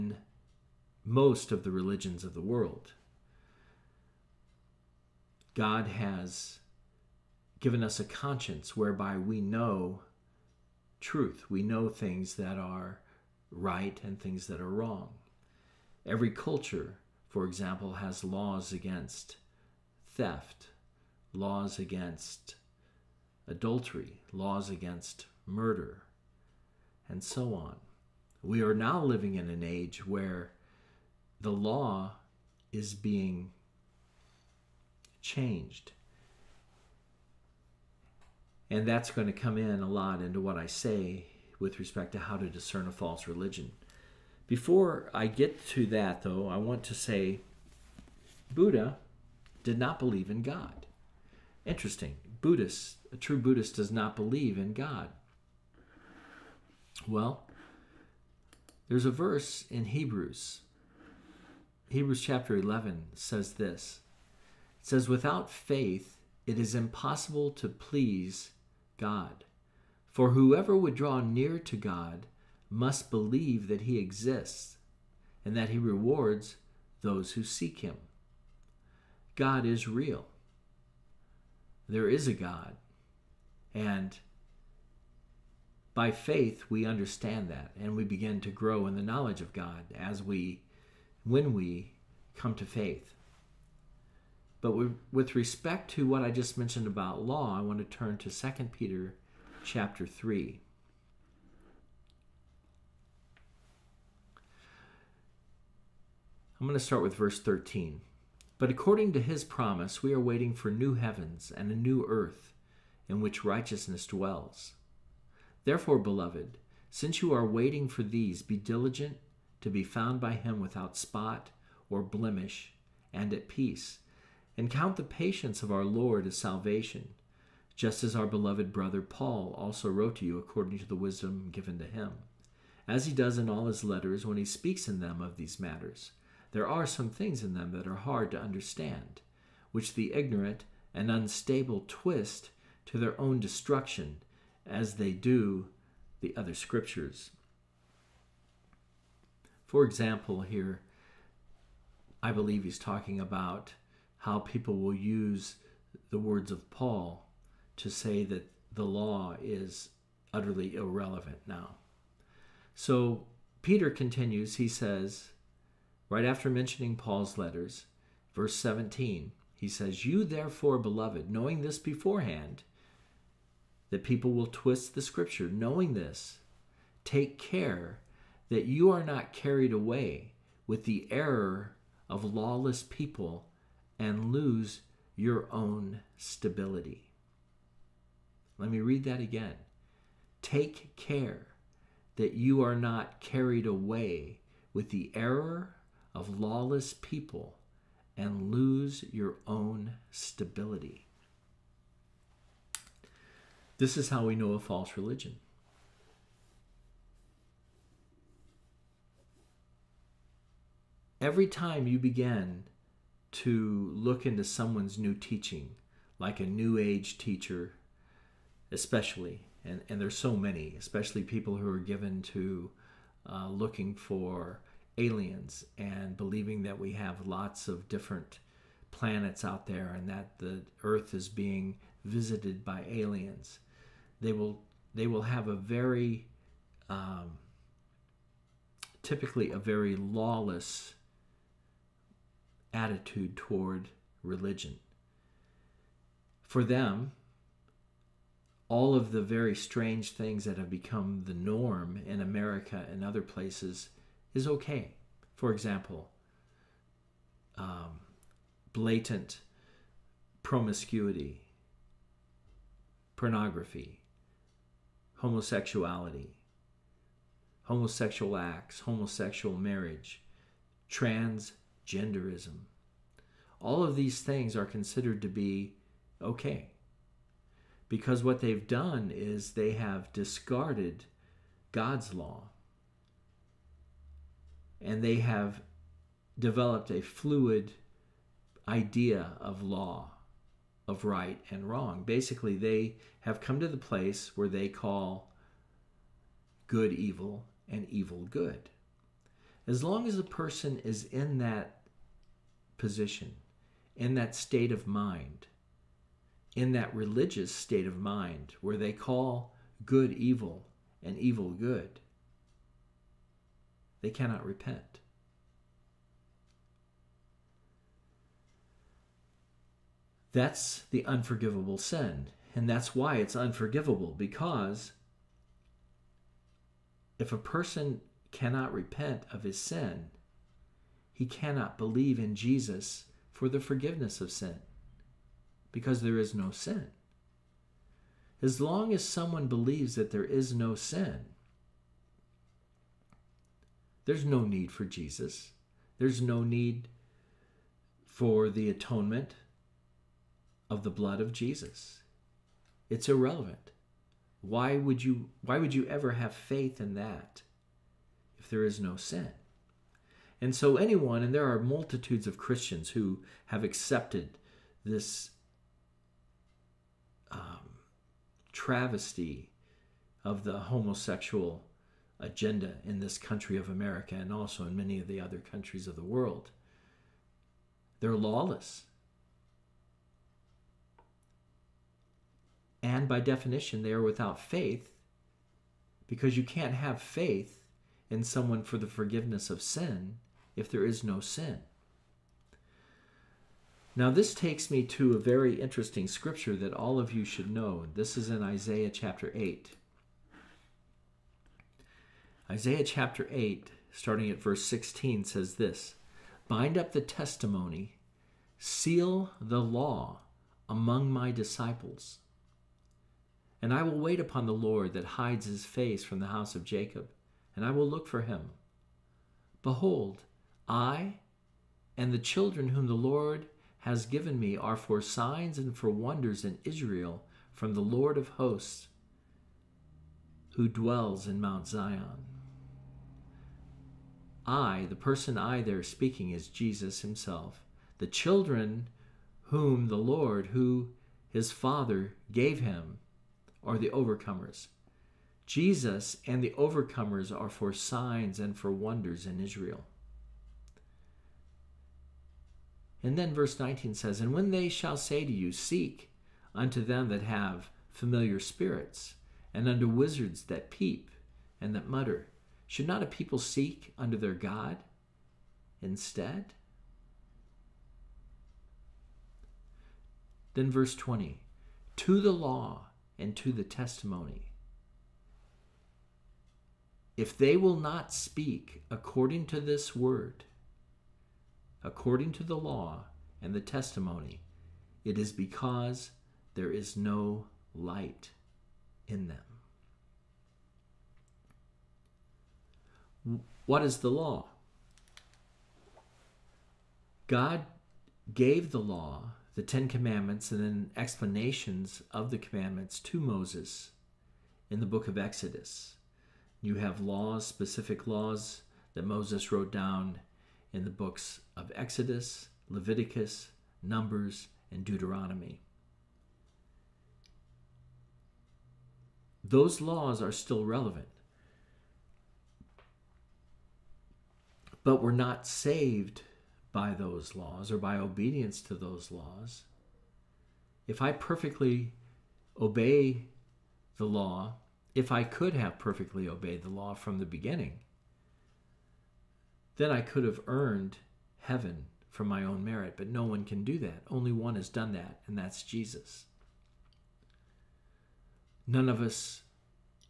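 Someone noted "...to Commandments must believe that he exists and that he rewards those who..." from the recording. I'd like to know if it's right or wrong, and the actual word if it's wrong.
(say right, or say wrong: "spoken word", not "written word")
wrong: "God", not "Commandments".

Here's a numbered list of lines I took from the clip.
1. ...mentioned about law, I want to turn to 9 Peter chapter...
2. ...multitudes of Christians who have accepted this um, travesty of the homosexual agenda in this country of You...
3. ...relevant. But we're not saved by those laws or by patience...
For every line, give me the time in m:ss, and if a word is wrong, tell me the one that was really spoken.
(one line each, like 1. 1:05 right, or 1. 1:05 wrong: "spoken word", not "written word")
1. 1:36 wrong: "2", not "9"
2. 6:01 wrong: "America", not "You"
3. 8:40 wrong: "obedience", not "patience".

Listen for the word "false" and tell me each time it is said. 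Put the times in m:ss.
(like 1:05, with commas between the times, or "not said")
0:42, 3:24.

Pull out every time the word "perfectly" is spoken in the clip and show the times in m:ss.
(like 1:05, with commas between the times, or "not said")
8:51, 8:55.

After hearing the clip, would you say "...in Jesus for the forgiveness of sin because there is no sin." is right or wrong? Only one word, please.
right.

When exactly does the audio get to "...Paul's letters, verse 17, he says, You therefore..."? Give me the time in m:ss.
2:46.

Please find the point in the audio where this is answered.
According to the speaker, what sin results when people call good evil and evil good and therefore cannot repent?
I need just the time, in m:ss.
5:20.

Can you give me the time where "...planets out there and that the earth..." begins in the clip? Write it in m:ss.
3:48.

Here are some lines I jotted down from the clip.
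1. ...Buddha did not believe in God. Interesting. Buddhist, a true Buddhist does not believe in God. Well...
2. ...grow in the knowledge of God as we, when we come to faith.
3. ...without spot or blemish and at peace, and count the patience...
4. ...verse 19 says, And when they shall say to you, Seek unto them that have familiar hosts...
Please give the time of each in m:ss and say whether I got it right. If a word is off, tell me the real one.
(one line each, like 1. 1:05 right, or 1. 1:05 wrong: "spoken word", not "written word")
1. 0:48 right
2. 1:28 right
3. 2:00 right
4. 7:33 wrong: "spirits", not "hosts".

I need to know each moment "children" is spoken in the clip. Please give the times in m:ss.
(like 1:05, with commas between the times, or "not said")
7:02, 7:18.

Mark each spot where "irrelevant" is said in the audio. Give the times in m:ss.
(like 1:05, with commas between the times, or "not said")
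2:40, 5:53.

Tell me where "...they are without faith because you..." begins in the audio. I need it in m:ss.
6:23.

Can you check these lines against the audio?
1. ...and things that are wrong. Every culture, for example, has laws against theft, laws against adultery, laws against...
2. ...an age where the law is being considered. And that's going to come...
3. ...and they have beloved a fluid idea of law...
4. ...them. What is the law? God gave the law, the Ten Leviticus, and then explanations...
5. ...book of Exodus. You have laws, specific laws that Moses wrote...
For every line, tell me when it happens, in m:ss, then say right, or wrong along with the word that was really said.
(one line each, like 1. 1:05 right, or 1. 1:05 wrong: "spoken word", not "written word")
1. 0:14 right
2. 0:29 wrong: "changed", not "considered"
3. 4:44 wrong: "developed", not "beloved"
4. 8:09 wrong: "Commandments", not "Leviticus"
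5. 8:24 right.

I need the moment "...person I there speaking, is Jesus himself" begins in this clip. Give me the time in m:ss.
7:14.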